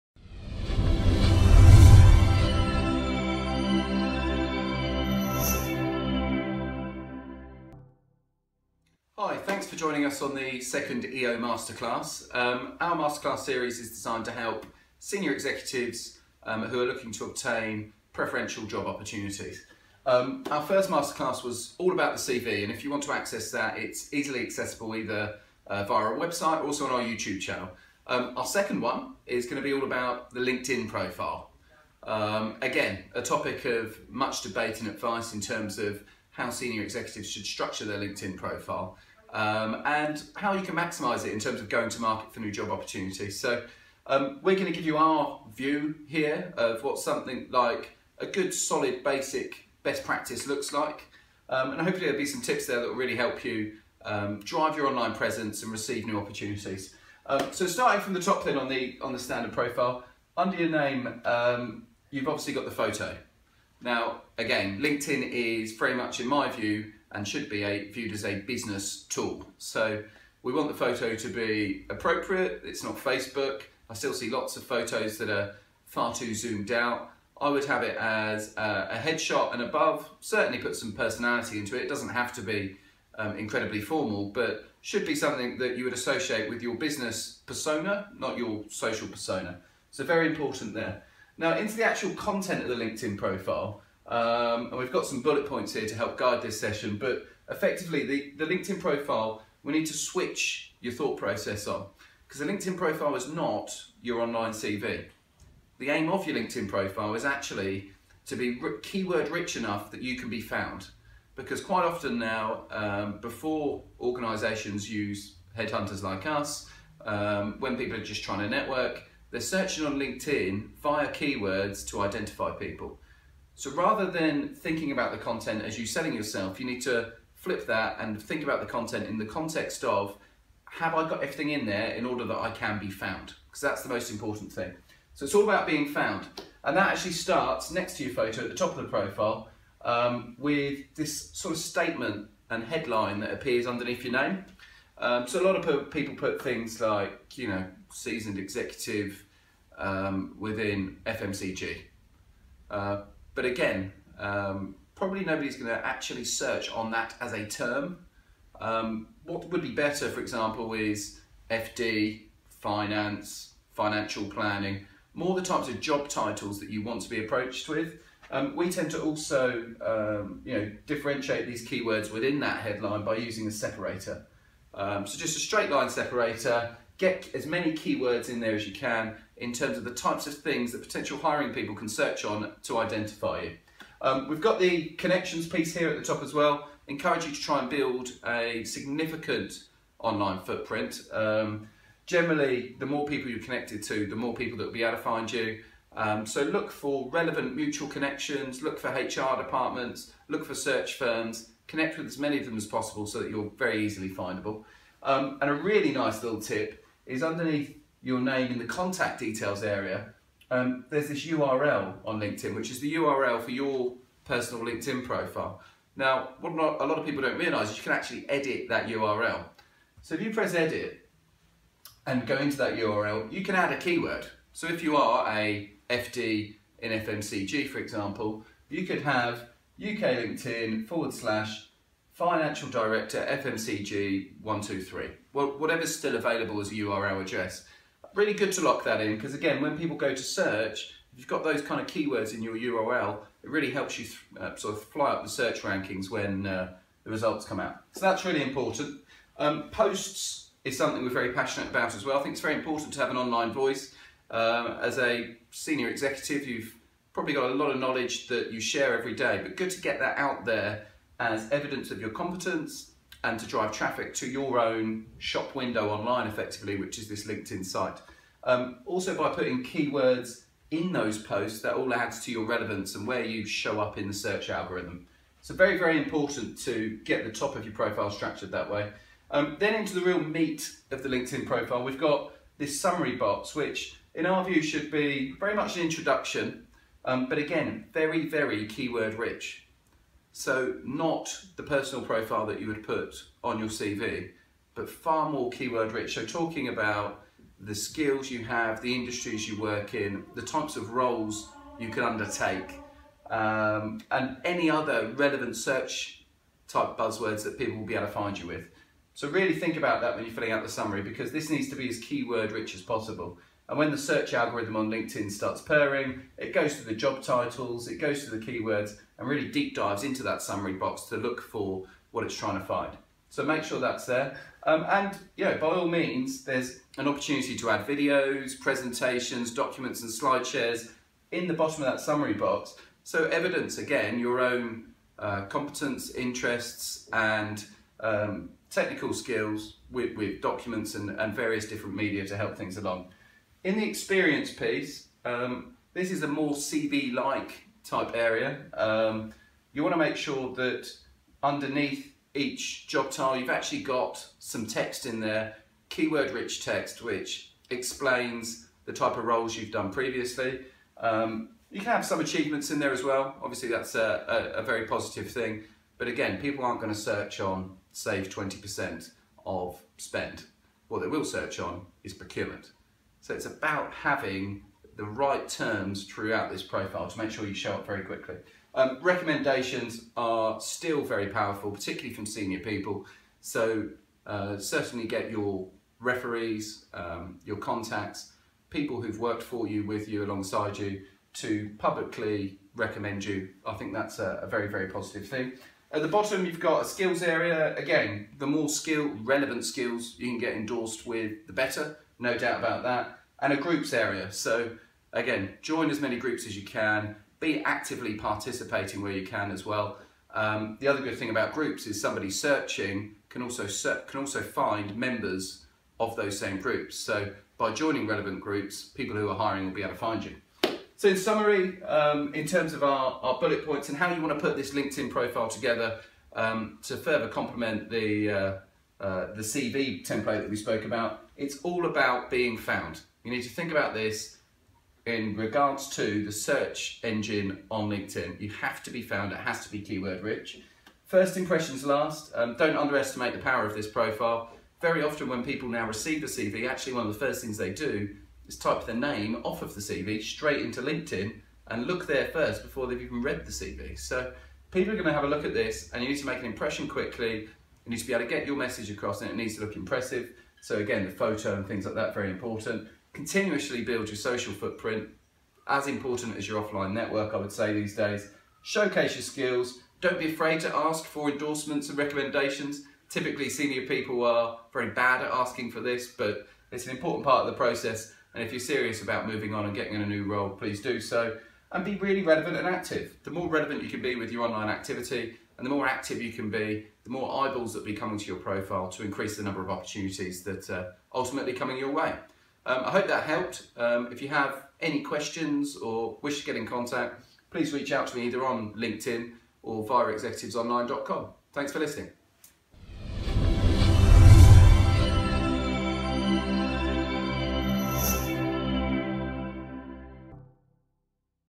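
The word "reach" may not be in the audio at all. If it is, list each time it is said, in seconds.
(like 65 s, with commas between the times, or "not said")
497 s.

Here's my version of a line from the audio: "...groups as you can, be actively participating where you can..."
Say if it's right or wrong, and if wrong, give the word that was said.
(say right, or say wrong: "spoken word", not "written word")
right.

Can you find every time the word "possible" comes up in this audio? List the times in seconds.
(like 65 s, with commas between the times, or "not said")
202 s, 312 s.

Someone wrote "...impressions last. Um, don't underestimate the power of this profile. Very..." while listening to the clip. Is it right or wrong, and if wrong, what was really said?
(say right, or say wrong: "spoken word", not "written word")
right.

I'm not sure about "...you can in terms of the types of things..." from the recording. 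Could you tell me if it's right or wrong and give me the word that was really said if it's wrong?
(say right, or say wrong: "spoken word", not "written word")
right.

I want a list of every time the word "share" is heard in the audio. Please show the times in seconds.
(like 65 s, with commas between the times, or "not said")
258 s, 330 s.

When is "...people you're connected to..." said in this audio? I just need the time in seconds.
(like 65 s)
193 s.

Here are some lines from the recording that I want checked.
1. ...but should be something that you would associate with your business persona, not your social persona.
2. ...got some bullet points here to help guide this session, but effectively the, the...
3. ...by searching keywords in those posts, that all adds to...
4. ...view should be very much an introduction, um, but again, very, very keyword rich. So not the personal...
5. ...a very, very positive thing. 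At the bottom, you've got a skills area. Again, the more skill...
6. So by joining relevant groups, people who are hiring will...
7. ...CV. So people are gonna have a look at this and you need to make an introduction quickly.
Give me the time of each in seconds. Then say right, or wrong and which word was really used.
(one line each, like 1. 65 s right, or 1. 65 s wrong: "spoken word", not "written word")
1. 84 s right
2. 94 s right
3. 269 s wrong: "putting", not "searching"
4. 284 s right
5. 394 s right
6. 416 s right
7. 453 s wrong: "impression", not "introduction".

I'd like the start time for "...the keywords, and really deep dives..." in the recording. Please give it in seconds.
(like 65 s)
318 s.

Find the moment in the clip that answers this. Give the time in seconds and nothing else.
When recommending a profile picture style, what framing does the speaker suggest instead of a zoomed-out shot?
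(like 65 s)
78 s.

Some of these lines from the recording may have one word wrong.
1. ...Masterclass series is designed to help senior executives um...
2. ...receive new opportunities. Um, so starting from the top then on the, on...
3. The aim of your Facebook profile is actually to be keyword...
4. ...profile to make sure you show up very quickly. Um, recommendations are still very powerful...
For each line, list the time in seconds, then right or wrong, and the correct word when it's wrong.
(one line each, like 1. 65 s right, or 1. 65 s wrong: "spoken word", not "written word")
1. 12 s right
2. 55 s right
3. 105 s wrong: "LinkedIn", not "Facebook"
4. 376 s right.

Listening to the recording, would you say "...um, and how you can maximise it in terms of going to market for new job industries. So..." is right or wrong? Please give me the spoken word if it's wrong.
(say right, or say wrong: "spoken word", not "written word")
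wrong: "opportunities", not "industries".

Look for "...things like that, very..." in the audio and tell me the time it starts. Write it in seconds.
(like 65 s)
461 s.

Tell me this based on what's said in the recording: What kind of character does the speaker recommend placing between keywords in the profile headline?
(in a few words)
Straight line separator.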